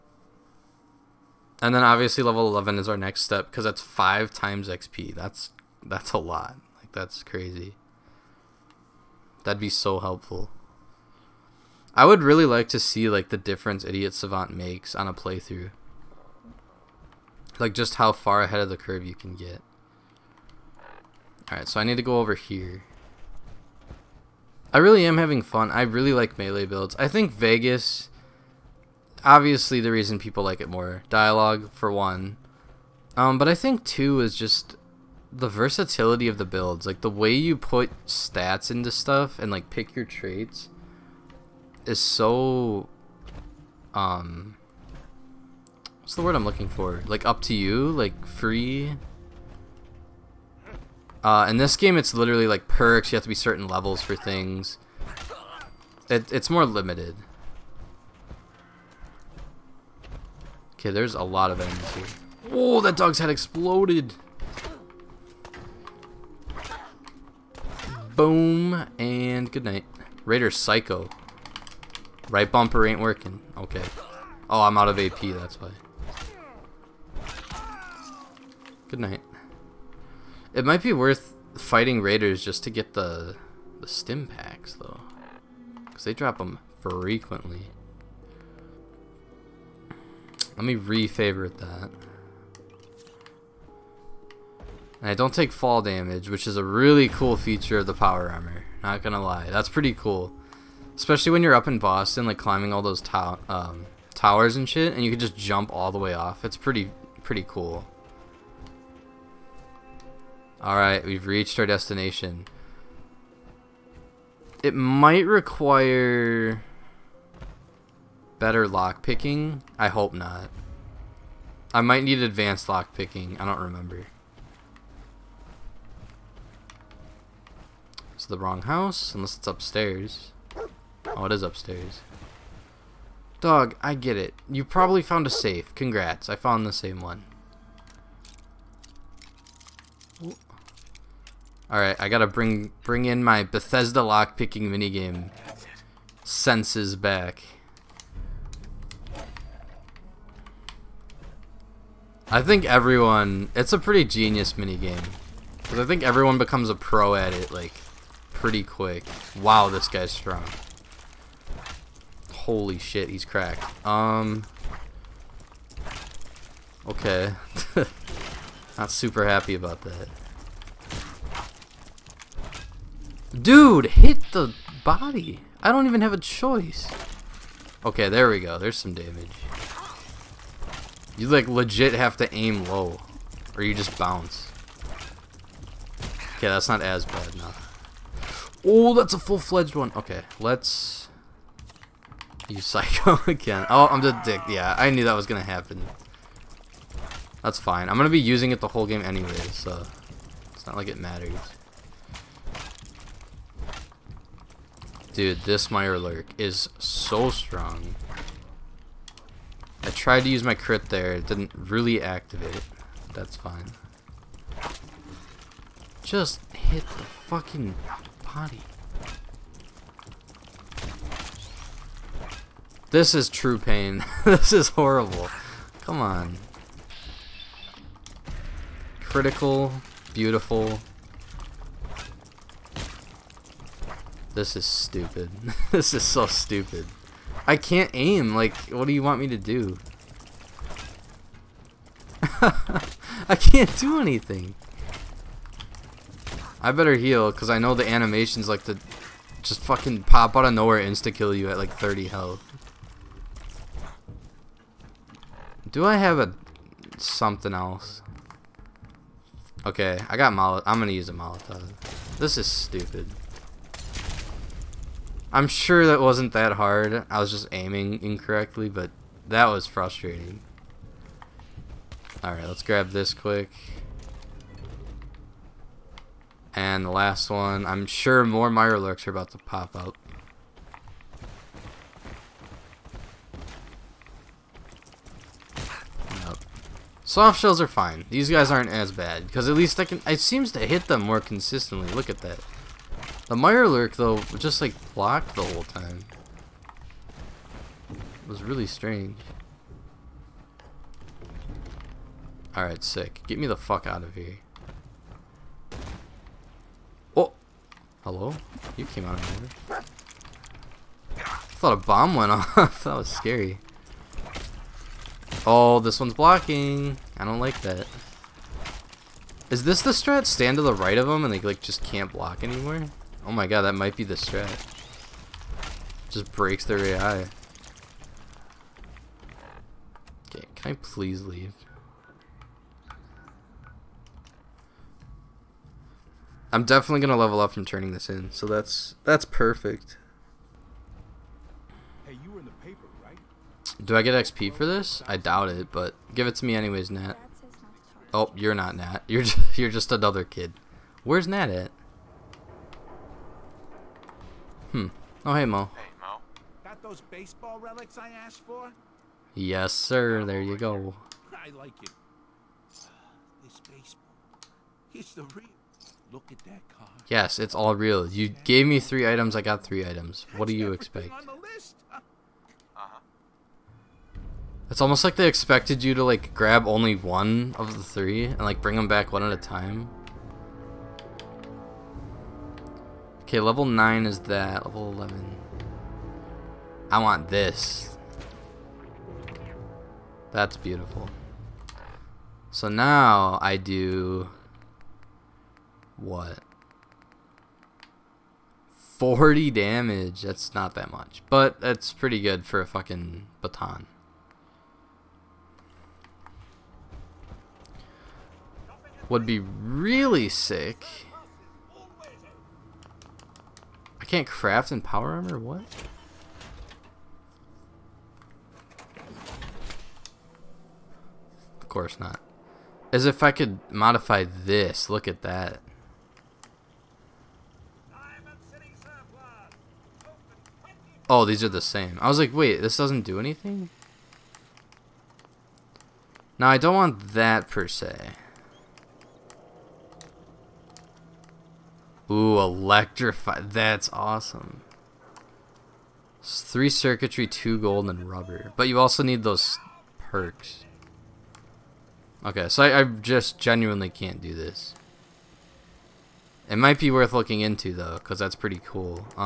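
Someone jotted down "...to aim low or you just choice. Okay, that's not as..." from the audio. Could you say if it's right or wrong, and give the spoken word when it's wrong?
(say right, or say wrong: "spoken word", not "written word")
wrong: "bounce", not "choice".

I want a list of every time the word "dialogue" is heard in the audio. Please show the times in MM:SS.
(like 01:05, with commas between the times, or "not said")
00:31.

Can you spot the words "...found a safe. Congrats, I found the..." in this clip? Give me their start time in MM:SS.
02:15.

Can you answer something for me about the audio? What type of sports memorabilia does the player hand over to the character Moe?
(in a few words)
Baseball relics.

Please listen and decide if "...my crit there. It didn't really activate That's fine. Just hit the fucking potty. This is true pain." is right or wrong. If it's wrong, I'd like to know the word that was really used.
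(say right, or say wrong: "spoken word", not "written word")
right.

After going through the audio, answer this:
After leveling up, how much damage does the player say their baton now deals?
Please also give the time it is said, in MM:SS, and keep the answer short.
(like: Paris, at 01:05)
40, at 06:38.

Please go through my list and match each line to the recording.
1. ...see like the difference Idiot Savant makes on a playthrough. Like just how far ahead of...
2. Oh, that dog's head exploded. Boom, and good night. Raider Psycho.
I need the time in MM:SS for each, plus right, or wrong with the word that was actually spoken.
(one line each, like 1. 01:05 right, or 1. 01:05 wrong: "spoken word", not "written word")
1. 00:12 right
2. 01:02 right.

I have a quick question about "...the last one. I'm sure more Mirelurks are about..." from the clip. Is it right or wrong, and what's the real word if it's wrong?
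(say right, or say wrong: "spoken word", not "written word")
right.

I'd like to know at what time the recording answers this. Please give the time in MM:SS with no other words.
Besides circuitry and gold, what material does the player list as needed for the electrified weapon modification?
07:28.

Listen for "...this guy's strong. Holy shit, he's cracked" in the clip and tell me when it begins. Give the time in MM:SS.
02:39.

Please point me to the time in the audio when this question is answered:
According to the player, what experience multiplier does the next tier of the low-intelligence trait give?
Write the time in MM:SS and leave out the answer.
00:03.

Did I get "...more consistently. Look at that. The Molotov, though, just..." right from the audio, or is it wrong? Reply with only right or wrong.
wrong.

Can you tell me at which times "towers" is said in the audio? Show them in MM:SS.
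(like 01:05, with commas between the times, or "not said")
01:44.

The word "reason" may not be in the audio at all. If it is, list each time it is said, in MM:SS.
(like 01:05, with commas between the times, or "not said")
00:29.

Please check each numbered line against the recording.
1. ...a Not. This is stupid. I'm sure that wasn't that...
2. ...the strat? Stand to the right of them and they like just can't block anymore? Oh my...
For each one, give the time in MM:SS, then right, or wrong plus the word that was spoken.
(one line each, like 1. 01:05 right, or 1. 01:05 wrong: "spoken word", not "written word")
1. 04:21 wrong: "Molotov", not "Not"
2. 05:19 right.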